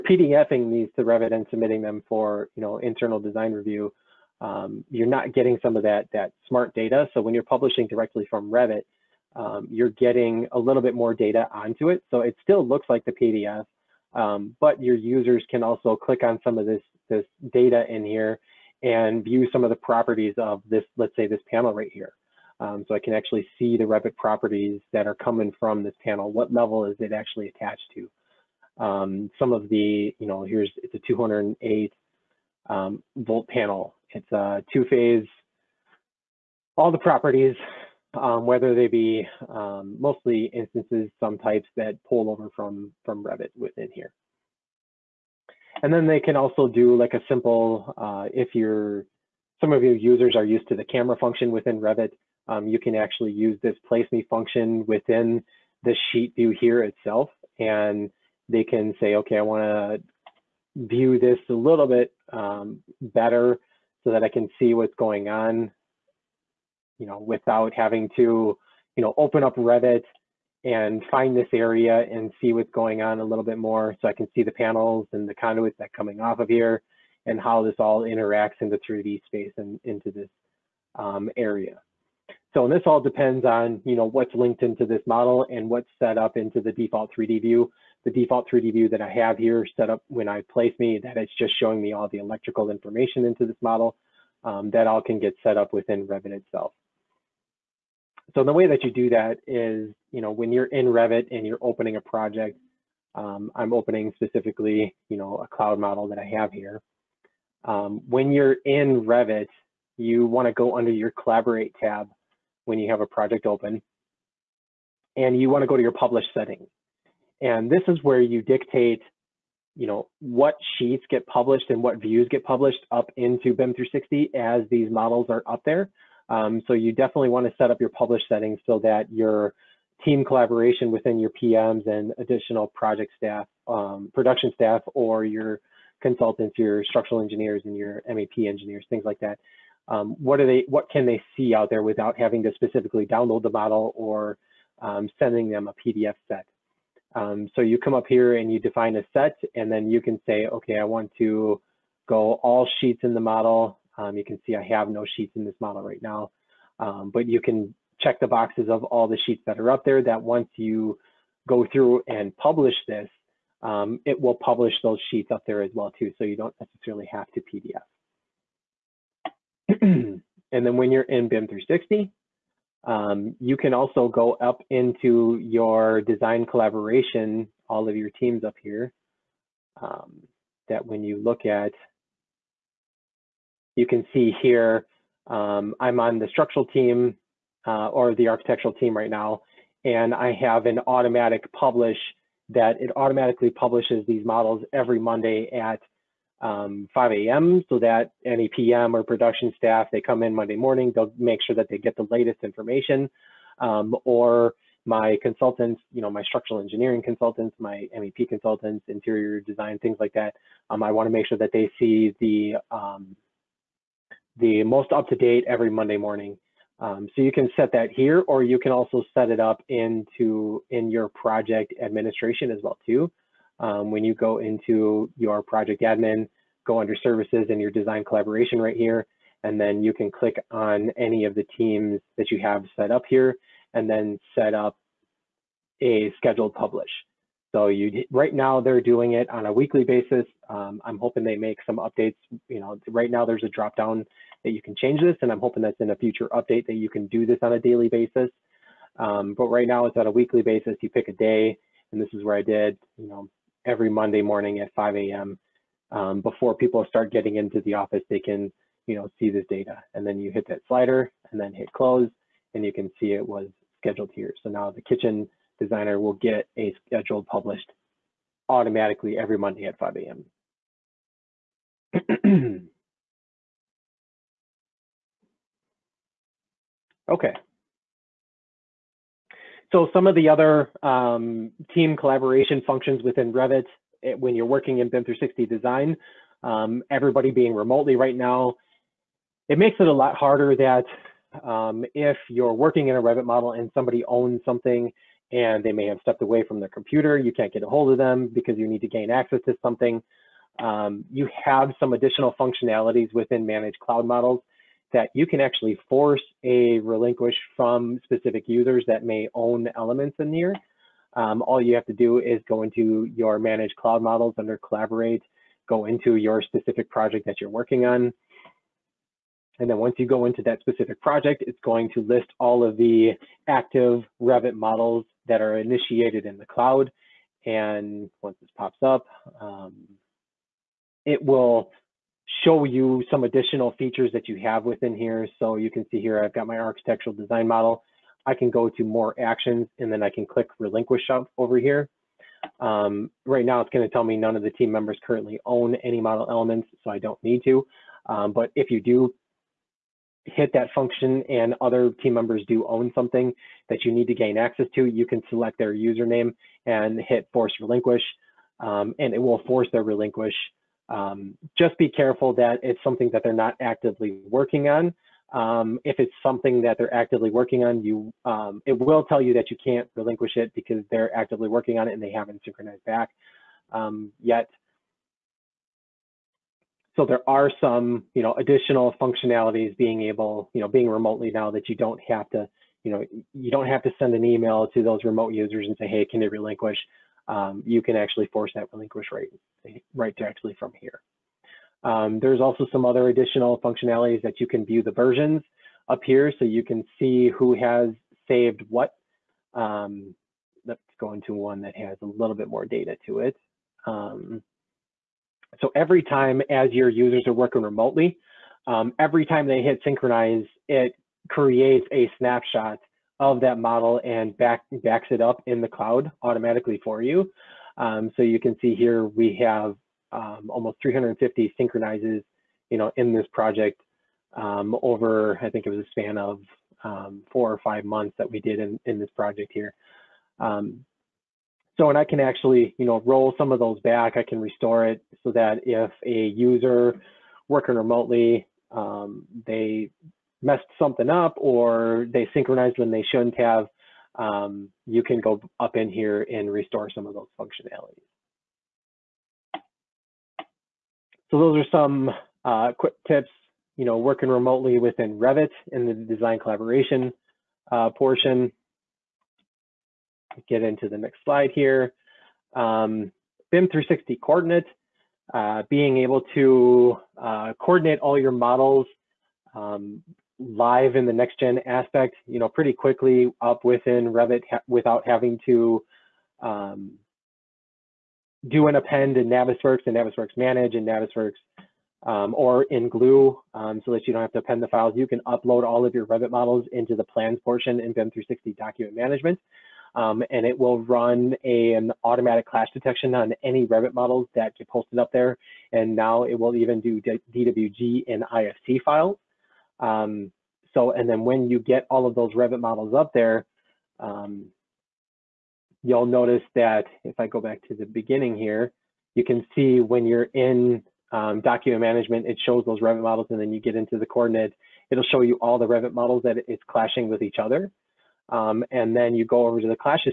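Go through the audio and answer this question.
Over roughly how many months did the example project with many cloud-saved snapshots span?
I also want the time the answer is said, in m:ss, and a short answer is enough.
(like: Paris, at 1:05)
four or five, at 7:07.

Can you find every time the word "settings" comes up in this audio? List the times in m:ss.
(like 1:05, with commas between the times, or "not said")
1:56, 2:08.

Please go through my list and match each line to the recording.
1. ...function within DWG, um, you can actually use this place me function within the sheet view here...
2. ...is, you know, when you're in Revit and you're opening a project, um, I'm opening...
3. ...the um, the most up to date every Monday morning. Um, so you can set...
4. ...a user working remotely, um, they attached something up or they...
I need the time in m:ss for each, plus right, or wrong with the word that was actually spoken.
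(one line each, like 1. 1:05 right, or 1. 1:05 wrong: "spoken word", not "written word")
1. 0:51 wrong: "Revit", not "DWG"
2. 1:39 right
3. 3:32 right
4. 7:16 wrong: "messed", not "attached".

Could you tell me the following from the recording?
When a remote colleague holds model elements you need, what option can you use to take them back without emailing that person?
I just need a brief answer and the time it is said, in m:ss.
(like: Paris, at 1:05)
force relinquish, at 5:57.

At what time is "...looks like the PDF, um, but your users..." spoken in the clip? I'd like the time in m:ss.
0:12.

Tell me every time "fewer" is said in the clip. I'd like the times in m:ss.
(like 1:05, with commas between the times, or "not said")
not said.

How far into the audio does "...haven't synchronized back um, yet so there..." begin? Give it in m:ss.
6:12.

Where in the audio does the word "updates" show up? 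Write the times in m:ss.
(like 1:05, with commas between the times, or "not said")
4:01, 4:06.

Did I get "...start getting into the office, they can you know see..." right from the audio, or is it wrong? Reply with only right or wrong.
right.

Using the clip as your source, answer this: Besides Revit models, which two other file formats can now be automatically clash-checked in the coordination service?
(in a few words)
DWG and IFC.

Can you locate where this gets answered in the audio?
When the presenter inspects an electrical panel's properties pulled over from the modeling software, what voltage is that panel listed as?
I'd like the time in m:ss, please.
0:31.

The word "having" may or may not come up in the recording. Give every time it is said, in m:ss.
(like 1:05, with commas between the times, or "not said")
1:07, 2:22, 7:55.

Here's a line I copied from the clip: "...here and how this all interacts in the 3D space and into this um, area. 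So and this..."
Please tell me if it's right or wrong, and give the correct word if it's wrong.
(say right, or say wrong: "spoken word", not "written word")
right.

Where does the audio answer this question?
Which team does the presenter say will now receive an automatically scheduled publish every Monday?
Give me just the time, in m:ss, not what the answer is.
4:24.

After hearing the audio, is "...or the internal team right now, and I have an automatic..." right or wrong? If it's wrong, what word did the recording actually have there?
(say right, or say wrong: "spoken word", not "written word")
wrong: "architectural", not "internal".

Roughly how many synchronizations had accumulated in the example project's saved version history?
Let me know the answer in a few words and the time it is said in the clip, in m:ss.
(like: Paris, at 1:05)
350, at 7:00.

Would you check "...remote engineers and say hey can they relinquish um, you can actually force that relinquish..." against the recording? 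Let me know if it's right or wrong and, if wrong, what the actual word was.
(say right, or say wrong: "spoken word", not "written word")
wrong: "users", not "engineers".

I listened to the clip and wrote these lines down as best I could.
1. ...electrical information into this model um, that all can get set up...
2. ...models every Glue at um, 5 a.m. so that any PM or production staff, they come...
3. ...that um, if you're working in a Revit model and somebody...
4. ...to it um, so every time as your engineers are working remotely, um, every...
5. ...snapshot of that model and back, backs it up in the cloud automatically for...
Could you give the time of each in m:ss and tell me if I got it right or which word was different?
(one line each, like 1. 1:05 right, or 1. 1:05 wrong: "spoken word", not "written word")
1. 1:32 right
2. 3:14 wrong: "Monday", not "Glue"
3. 4:50 right
4. 6:43 wrong: "users", not "engineers"
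5. 6:52 right.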